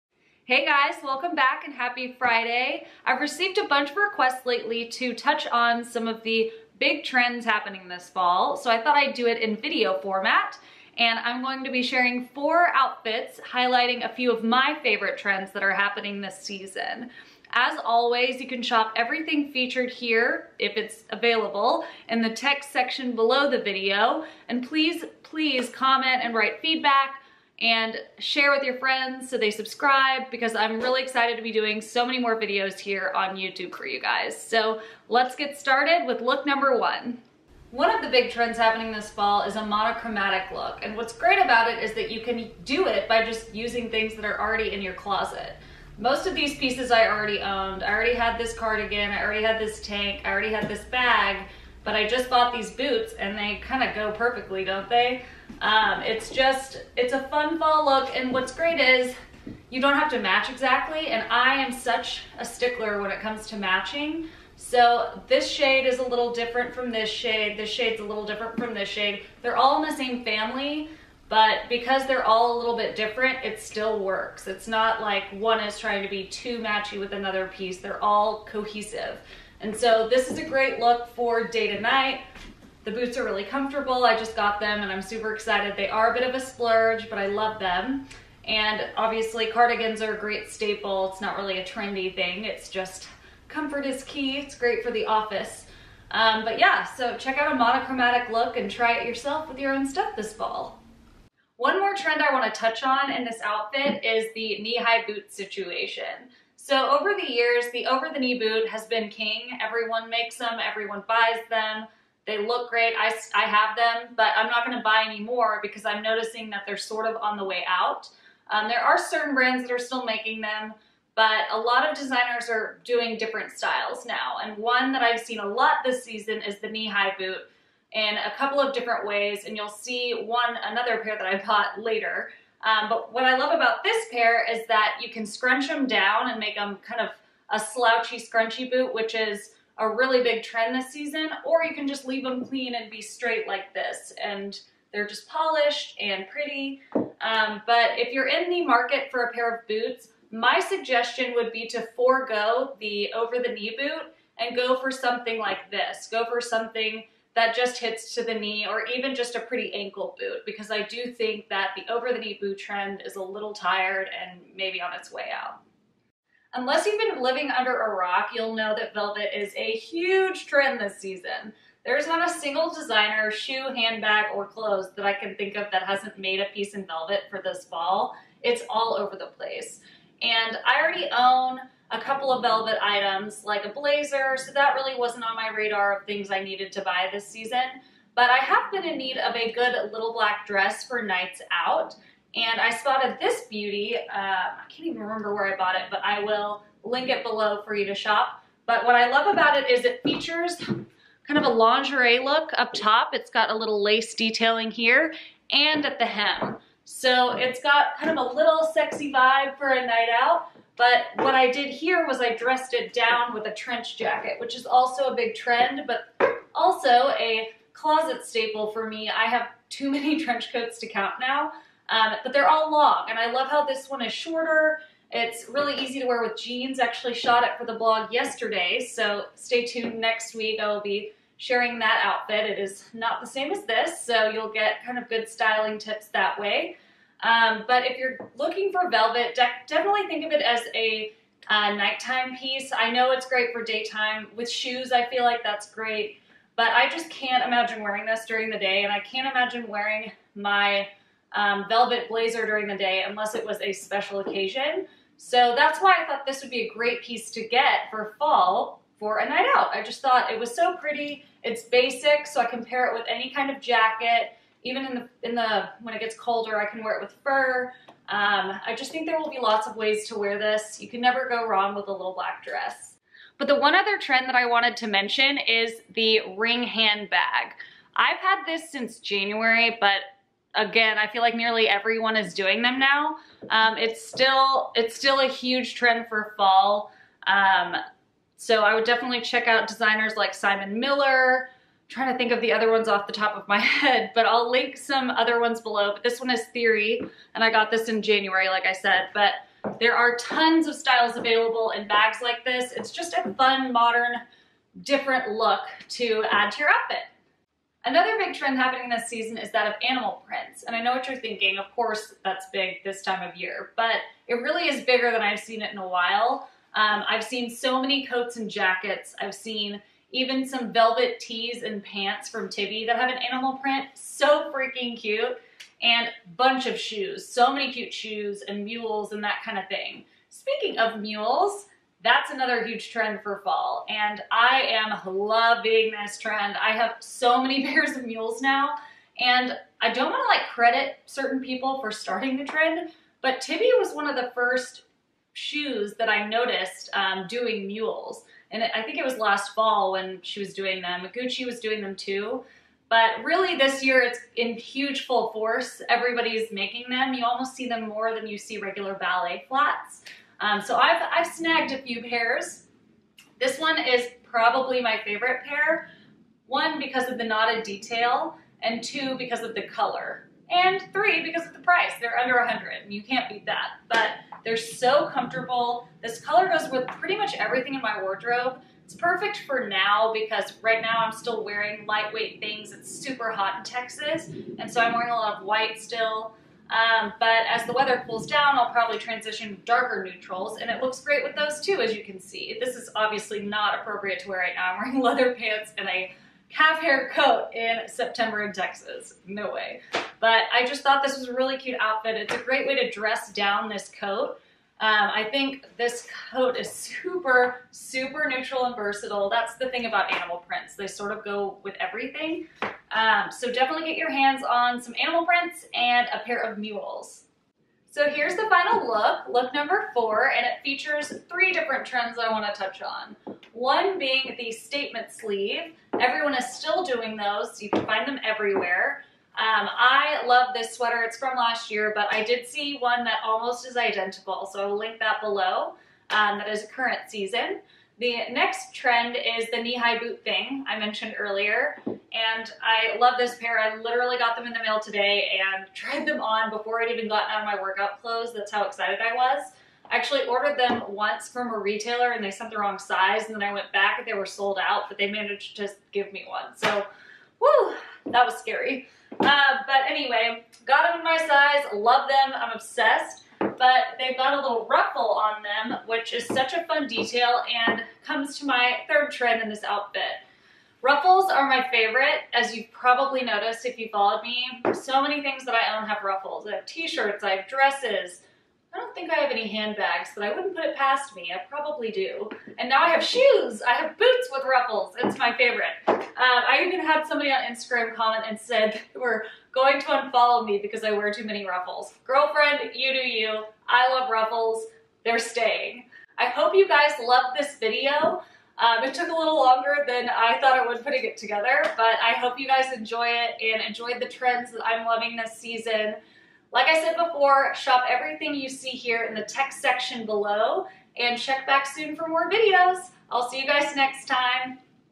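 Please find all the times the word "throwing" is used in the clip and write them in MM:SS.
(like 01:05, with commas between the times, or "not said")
not said.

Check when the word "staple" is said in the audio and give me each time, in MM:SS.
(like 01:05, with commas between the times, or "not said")
01:30, 03:38.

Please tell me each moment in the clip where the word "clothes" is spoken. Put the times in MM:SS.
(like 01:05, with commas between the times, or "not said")
02:54, 07:28.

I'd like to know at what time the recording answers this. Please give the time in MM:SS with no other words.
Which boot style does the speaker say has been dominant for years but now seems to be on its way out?
01:47.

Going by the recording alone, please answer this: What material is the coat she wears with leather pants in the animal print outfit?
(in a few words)
calf hair.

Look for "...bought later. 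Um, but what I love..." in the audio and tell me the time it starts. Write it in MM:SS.
02:11.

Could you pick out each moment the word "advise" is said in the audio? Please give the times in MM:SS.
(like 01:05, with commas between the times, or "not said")
not said.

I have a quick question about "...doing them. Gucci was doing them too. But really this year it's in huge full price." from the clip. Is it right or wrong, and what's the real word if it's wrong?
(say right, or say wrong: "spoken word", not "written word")
wrong: "force", not "price".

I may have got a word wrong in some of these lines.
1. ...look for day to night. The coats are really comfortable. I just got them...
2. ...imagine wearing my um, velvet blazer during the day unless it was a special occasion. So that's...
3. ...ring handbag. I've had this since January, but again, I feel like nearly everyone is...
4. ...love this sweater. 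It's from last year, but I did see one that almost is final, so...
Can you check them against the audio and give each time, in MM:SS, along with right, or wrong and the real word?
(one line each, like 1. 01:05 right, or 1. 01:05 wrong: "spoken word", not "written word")
1. 01:20 wrong: "boots", not "coats"
2. 04:09 right
3. 04:36 right
4. 07:10 wrong: "identical", not "final".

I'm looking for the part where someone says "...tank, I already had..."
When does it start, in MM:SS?
00:49.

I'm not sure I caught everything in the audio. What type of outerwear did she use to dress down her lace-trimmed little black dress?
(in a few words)
trench jacket.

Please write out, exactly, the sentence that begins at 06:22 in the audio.
It's super hot in Texas and so I'm wearing a lot of white still.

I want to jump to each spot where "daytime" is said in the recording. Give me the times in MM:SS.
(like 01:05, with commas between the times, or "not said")
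04:03.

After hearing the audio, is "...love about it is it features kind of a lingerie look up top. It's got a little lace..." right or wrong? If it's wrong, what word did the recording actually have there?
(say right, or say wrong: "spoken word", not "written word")
right.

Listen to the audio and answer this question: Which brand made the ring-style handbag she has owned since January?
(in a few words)
Theory.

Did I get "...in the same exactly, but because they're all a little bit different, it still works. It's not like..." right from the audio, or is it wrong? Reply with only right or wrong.
wrong.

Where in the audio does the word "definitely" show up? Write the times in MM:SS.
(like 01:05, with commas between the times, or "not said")
03:59, 04:48, 06:53.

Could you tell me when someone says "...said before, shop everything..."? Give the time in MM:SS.
08:26.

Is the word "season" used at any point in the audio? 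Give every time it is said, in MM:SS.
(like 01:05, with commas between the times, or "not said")
00:16, 02:06, 02:20, 02:50, 03:07, 05:09, 07:17, 08:25.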